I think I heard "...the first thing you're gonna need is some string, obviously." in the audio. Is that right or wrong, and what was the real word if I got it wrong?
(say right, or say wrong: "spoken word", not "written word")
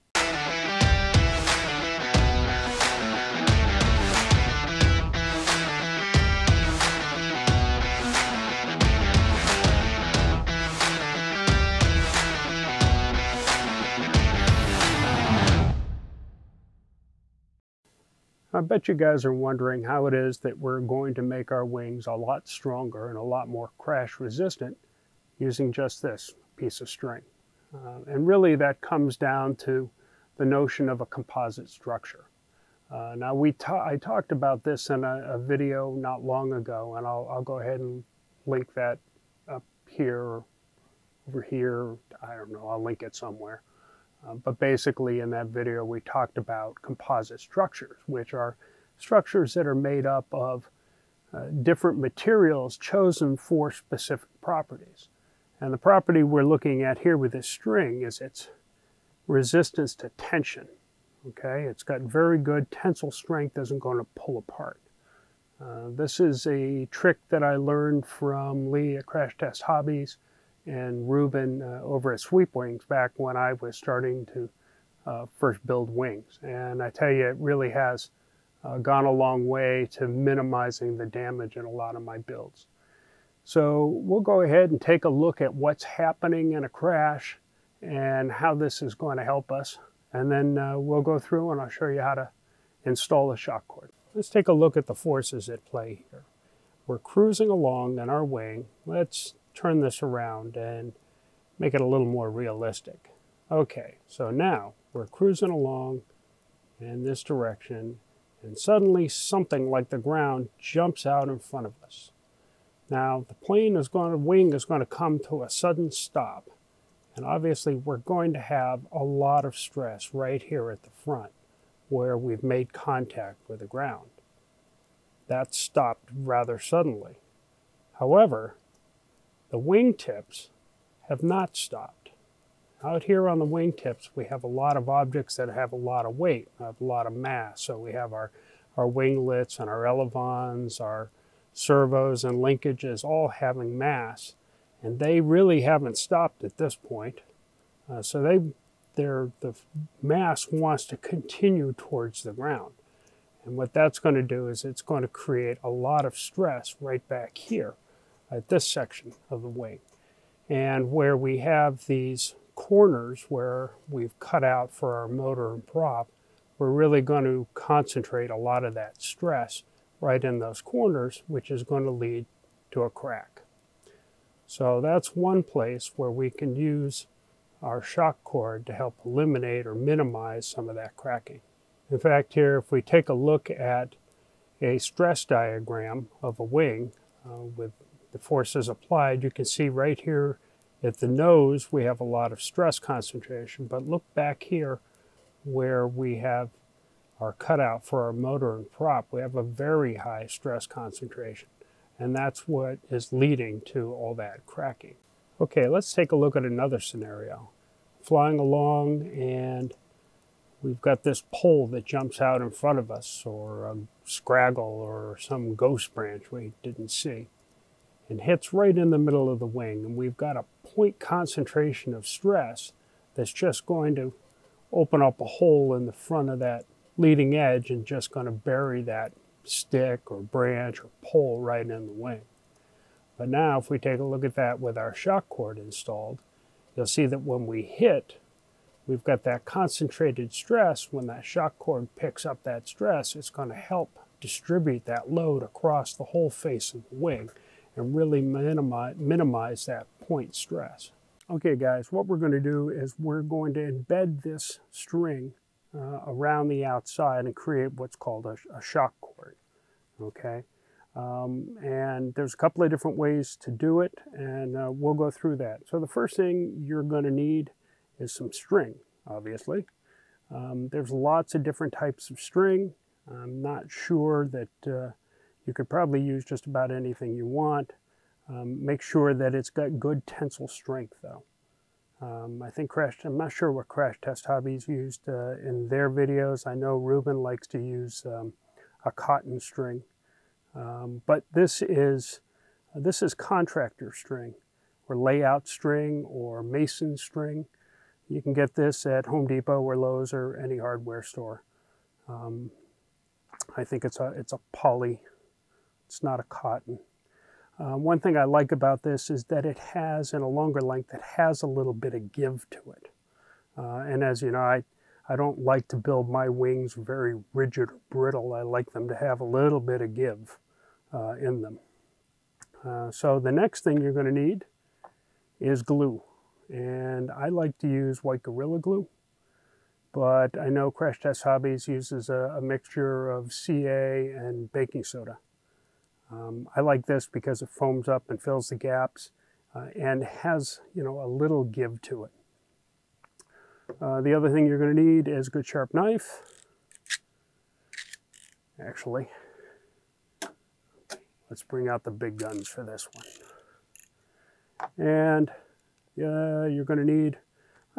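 right.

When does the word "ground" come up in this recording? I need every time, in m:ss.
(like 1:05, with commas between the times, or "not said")
1:49, 2:03, 2:32.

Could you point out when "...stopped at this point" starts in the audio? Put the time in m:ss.
2:25.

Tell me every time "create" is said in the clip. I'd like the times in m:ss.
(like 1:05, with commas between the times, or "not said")
2:35, 4:17.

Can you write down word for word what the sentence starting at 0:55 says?
And the property we're looking at here with this string is its resistance to tension.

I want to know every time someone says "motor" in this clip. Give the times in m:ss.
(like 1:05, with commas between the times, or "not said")
2:45, 3:18.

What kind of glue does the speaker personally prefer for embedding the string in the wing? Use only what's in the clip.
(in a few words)
white Gorilla Glue.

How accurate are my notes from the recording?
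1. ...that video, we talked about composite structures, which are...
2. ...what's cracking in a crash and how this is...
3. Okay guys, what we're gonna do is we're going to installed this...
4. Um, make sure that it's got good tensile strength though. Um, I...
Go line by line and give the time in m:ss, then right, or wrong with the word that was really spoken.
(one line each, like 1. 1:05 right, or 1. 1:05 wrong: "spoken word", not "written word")
1. 0:45 right
2. 1:25 wrong: "happening", not "cracking"
3. 4:11 wrong: "embed", not "installed"
4. 4:38 right.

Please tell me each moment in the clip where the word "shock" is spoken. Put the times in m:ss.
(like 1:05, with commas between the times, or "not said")
1:33, 2:57, 3:54, 4:01, 4:18.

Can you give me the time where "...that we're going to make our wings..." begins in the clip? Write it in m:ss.
0:20.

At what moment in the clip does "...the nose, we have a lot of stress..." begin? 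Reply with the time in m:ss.
3:10.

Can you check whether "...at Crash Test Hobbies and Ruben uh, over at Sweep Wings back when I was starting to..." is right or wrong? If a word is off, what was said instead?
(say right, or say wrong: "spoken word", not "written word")
right.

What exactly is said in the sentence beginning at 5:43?
Uh, the other thing you're going to need is a good sharp knife, actually.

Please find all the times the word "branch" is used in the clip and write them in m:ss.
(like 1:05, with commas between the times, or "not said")
3:35, 3:50.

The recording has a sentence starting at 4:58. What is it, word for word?
You can get this at Home Depot or Lowe's or any hardware store.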